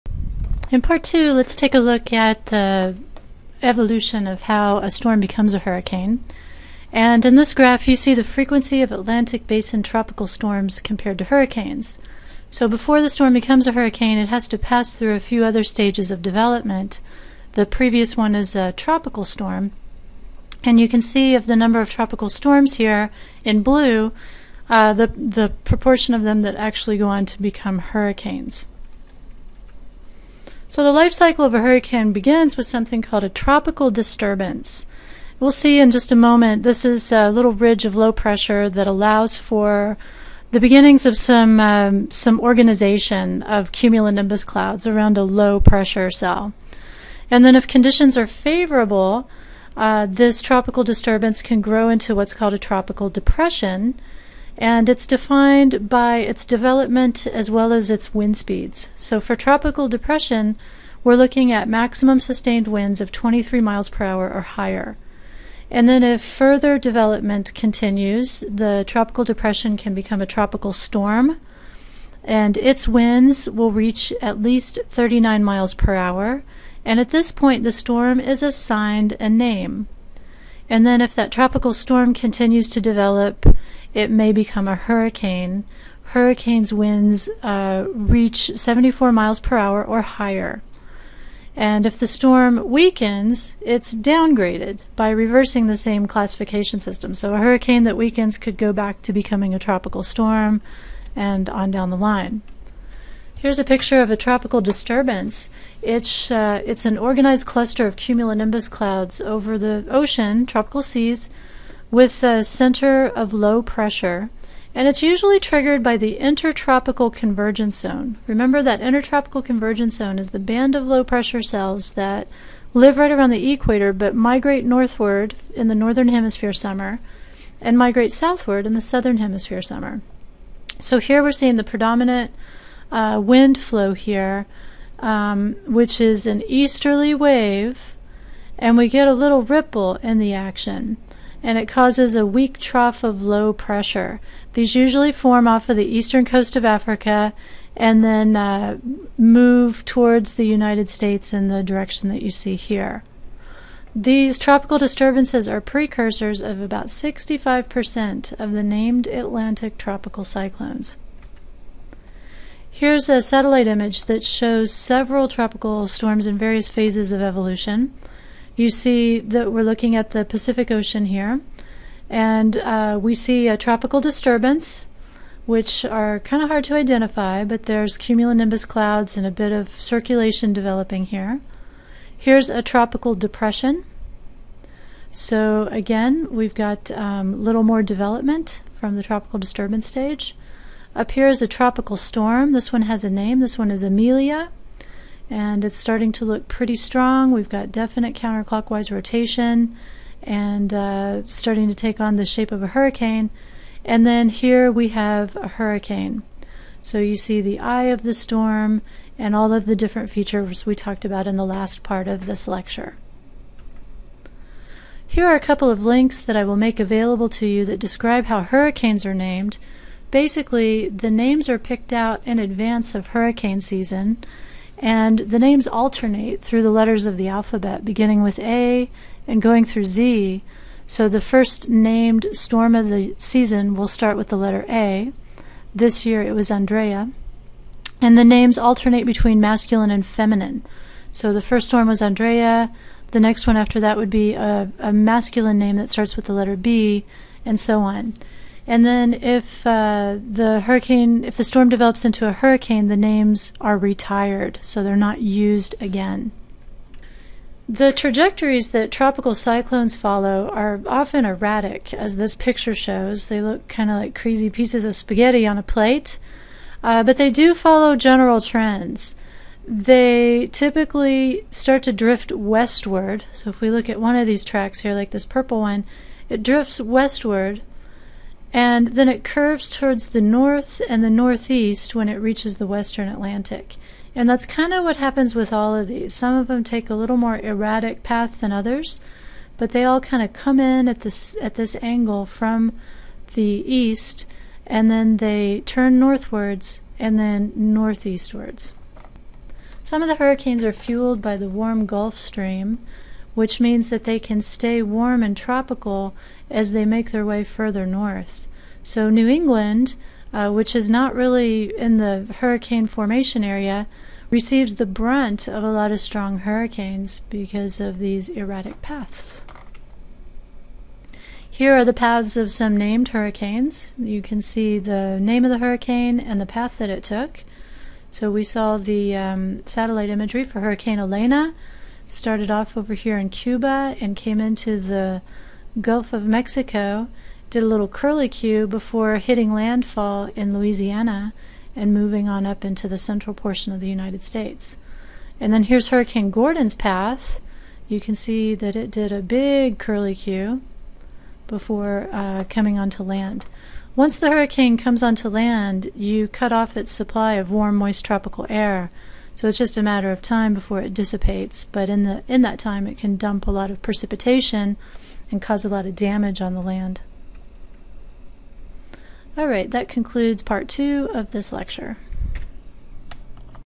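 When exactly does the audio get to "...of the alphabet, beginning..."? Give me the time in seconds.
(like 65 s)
227 s.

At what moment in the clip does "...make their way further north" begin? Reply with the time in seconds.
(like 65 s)
306 s.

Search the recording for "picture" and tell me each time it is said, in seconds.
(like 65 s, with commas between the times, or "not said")
103 s, 262 s.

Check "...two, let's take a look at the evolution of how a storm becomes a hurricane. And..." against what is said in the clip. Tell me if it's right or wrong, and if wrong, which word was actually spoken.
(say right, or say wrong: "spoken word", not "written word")
right.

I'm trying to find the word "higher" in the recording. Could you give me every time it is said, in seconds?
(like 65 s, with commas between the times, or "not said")
64 s, 90 s.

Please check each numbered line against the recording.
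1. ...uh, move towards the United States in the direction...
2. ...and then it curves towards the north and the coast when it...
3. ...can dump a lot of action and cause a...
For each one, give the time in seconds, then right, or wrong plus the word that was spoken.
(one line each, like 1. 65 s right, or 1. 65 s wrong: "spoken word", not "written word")
1. 148 s right
2. 278 s wrong: "northeast", not "coast"
3. 362 s wrong: "precipitation", not "action".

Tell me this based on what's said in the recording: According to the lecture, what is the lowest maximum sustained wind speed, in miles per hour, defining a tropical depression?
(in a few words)
23 miles per hour.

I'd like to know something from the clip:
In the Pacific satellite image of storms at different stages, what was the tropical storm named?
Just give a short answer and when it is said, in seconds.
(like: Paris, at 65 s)
Amelia, at 193 s.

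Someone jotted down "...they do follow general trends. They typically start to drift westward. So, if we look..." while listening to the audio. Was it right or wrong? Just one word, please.
right.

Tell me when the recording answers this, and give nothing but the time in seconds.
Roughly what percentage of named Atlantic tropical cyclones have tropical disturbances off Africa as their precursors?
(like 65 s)
156 s.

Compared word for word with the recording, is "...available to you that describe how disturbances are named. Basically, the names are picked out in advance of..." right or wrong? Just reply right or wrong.
wrong.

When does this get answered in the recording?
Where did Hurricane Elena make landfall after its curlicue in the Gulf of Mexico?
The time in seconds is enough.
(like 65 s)
340 s.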